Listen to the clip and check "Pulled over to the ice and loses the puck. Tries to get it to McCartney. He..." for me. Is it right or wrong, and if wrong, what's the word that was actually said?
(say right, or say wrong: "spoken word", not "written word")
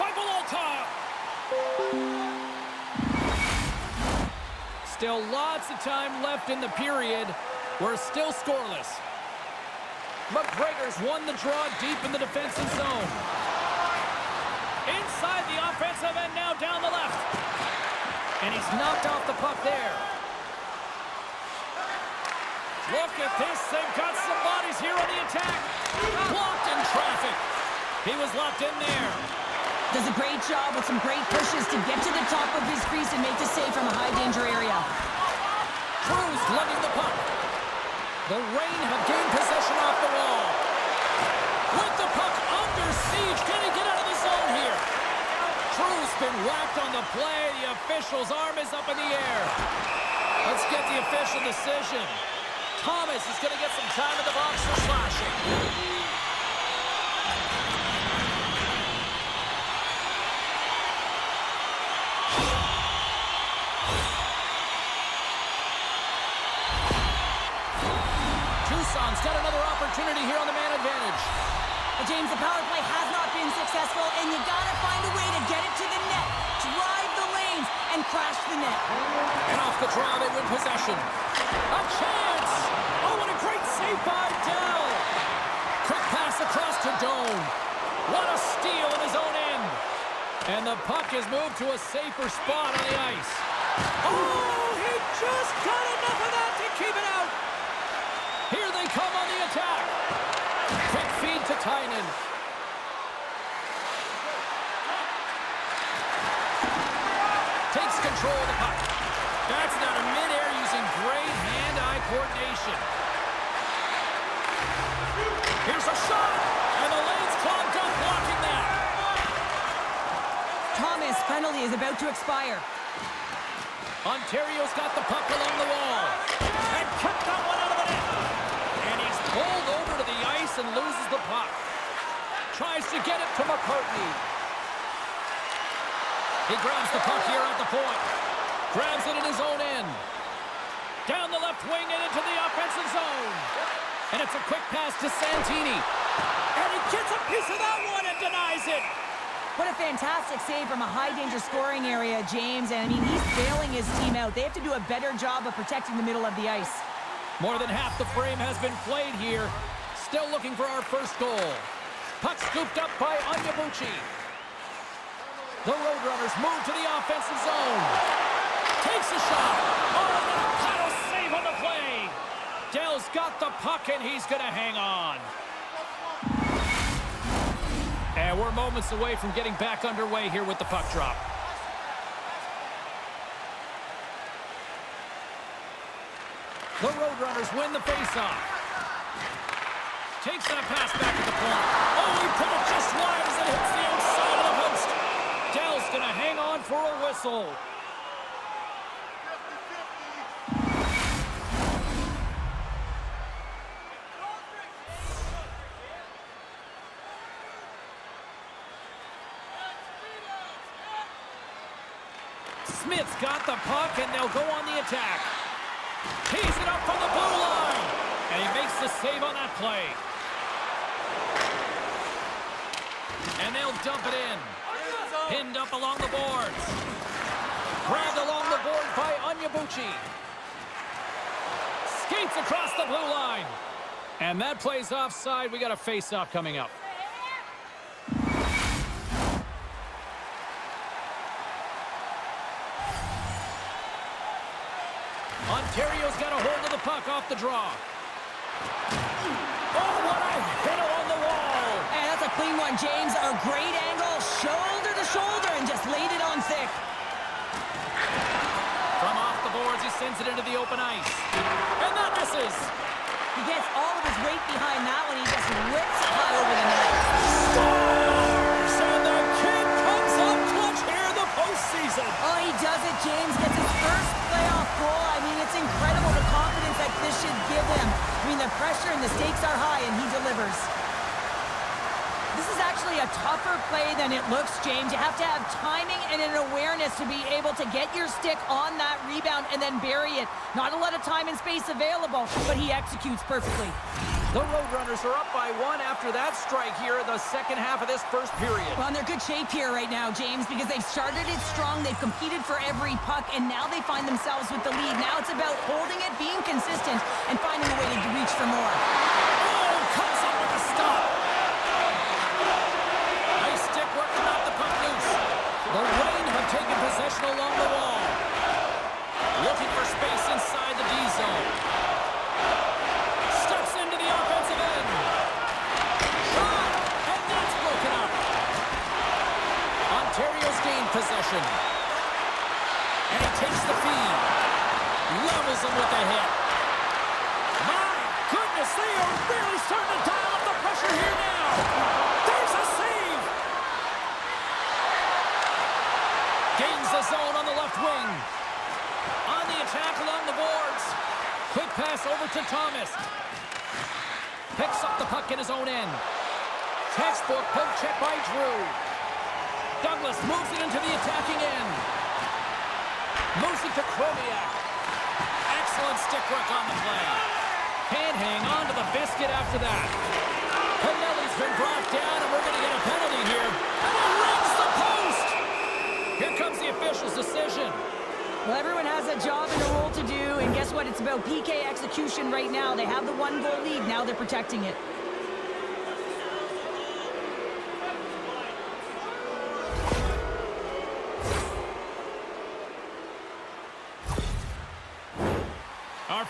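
right.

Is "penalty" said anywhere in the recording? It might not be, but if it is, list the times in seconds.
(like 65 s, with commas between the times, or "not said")
121 s, 376 s.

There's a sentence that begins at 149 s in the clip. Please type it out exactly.
What a fantastic save from a high-danger scoring area, James.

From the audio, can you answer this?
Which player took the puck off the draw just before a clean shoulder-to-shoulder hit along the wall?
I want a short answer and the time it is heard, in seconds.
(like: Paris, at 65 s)
Carrio, at 245 s.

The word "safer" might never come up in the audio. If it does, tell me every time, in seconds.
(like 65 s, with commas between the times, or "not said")
91 s.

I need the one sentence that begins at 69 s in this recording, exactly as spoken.
opportunity here on the man advantage.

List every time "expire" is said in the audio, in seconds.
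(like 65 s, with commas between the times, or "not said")
122 s.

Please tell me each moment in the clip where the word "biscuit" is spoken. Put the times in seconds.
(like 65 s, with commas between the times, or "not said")
368 s.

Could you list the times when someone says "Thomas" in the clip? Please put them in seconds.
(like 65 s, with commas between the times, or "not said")
52 s, 120 s, 352 s.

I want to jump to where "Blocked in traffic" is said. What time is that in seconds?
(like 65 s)
26 s.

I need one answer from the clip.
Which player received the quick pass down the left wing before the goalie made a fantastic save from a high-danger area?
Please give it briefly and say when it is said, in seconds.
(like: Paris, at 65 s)
Santini, at 145 s.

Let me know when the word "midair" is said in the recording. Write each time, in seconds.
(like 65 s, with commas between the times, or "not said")
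110 s.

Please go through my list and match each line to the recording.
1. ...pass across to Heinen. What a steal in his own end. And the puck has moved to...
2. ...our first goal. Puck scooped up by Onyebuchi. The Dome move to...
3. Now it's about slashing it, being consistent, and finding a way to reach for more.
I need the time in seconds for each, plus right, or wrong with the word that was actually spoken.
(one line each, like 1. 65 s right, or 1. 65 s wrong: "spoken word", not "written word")
1. 86 s wrong: "Dome", not "Heinen"
2. 160 s wrong: "Roadrunners", not "Dome"
3. 305 s wrong: "holding", not "slashing".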